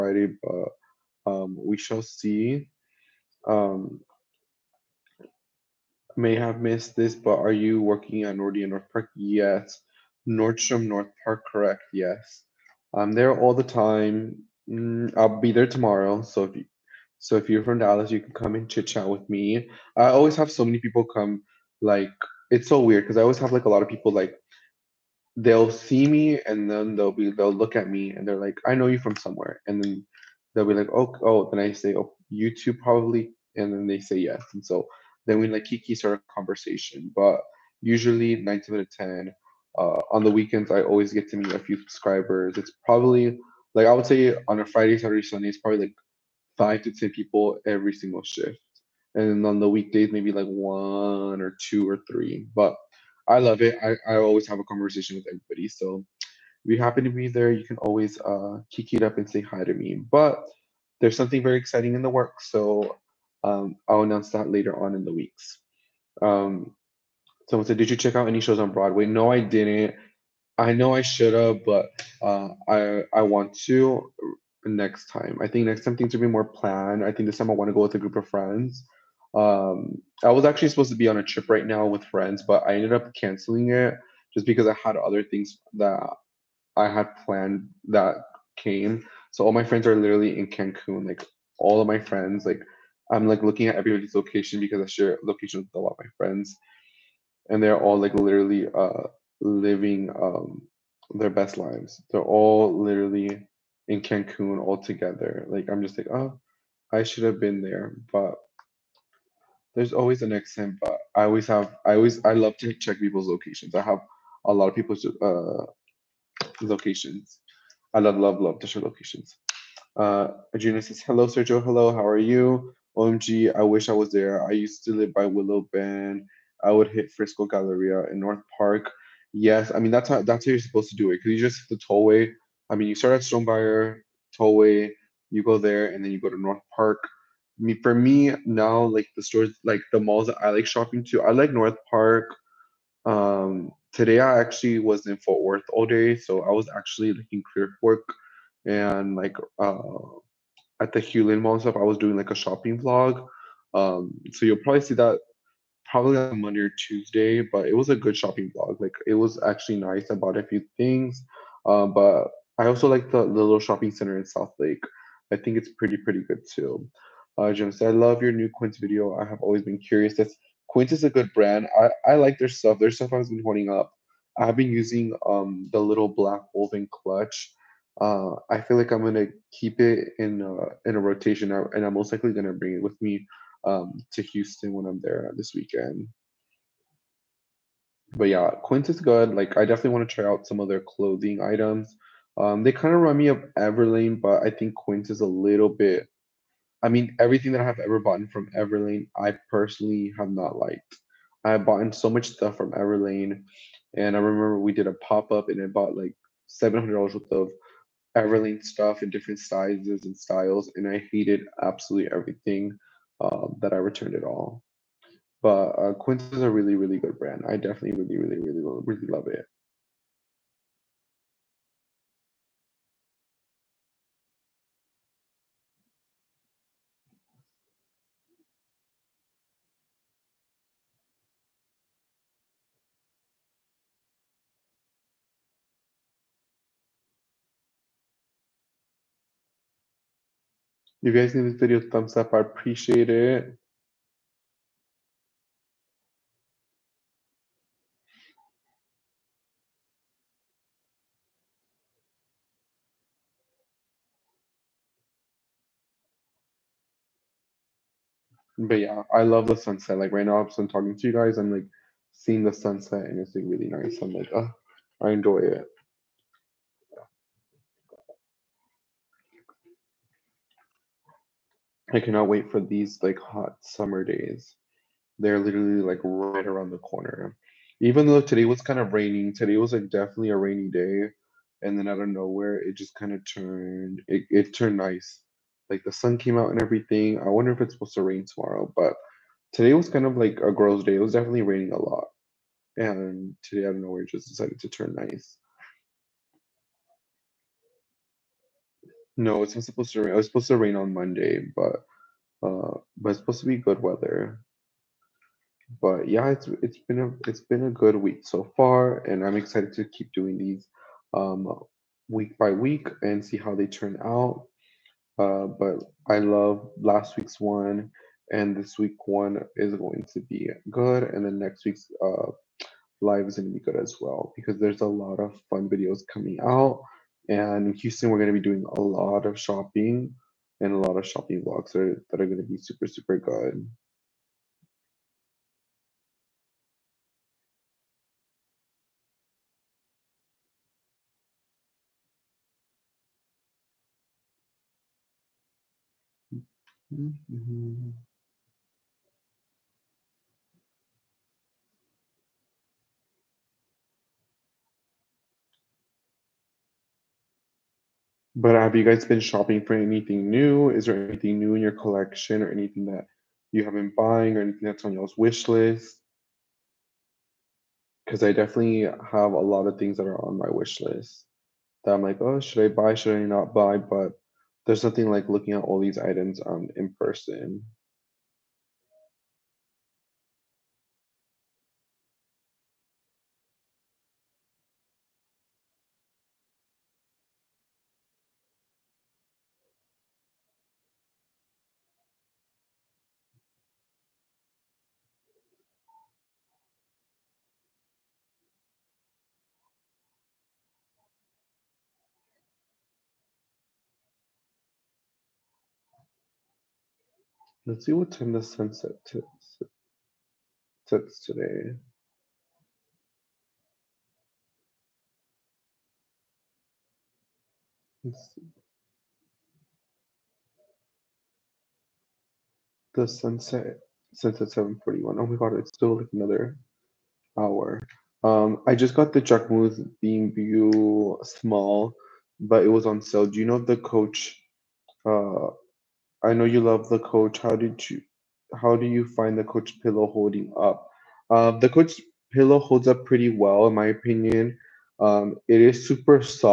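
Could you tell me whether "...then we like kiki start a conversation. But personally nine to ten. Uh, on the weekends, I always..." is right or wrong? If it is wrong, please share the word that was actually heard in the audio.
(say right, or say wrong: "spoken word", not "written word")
wrong: "usually", not "personally".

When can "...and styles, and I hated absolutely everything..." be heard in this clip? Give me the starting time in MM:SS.
03:30.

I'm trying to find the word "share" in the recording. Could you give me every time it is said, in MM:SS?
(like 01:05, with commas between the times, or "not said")
01:34, 01:58.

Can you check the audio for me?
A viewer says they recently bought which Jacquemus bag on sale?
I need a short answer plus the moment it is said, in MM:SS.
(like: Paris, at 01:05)
Beam View small, at 07:09.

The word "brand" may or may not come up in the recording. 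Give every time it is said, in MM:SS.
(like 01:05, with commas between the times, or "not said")
02:51, 03:37.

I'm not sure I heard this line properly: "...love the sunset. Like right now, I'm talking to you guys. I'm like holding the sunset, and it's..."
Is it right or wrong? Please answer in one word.
wrong.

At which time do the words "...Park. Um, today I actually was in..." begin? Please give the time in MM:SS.
02:21.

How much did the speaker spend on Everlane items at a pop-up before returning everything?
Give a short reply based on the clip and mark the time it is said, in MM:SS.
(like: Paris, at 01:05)
$700, at 03:26.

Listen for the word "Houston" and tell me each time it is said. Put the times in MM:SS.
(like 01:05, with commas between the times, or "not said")
03:04, 05:27.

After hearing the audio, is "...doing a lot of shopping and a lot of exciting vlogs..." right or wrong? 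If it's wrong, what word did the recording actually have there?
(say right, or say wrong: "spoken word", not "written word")
wrong: "shopping", not "exciting".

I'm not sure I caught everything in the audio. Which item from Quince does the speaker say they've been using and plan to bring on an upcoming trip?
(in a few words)
little black woven clutch.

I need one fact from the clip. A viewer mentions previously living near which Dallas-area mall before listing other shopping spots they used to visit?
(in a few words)
Willow Bend.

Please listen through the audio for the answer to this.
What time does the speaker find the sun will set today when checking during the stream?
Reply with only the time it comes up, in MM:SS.
07:04.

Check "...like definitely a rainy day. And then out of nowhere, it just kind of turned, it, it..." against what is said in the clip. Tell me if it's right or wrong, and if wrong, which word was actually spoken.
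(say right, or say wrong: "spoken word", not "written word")
right.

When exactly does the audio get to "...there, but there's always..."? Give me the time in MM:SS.
01:47.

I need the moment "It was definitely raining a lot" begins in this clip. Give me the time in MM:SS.
04:50.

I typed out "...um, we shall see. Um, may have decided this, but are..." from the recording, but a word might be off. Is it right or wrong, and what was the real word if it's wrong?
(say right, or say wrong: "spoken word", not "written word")
wrong: "missed", not "decided".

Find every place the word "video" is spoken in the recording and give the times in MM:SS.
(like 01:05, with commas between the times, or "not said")
02:48, 04:01, 05:25.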